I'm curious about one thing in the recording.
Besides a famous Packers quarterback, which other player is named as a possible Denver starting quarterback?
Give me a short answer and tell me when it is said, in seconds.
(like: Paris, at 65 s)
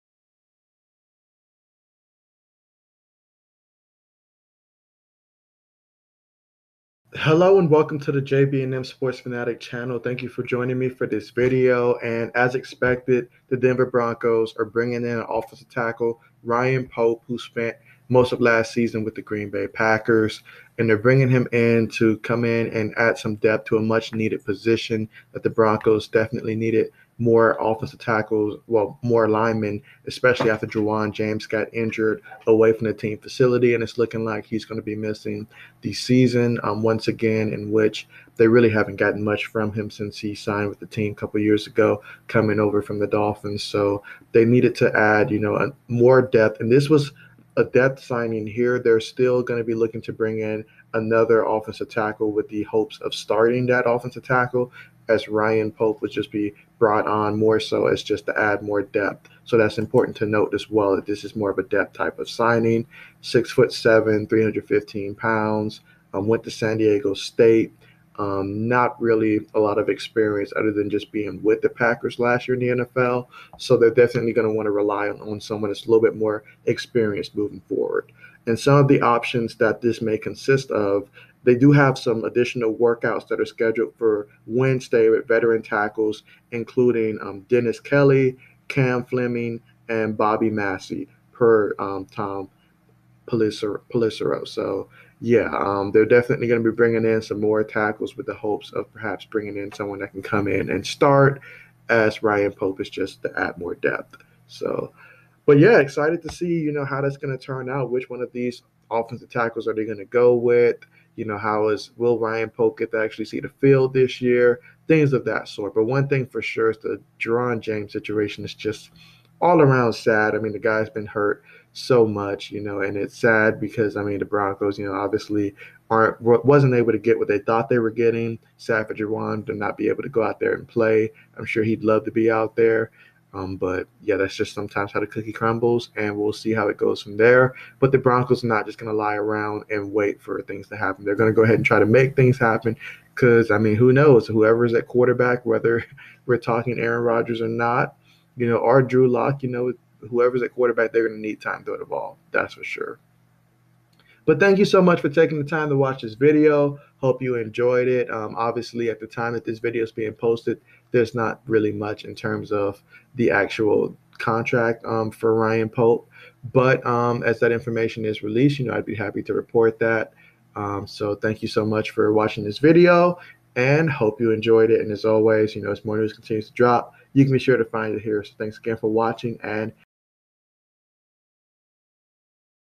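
Drew Lock, at 148 s.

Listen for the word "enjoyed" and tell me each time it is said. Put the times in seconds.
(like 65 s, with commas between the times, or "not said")
157 s, 174 s.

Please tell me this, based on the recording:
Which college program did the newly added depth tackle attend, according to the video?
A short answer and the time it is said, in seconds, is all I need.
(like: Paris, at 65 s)
San Diego State, at 66 s.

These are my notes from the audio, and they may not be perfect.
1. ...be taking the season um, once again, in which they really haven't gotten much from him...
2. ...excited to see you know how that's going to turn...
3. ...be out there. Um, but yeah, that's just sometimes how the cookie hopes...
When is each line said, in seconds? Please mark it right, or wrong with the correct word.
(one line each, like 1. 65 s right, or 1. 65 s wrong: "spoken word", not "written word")
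1. 34 s wrong: "missing", not "taking"
2. 105 s right
3. 132 s wrong: "crumbles", not "hopes".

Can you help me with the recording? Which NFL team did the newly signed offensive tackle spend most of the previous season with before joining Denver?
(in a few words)
Green Bay Packers.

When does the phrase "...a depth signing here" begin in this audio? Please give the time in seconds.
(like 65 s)
47 s.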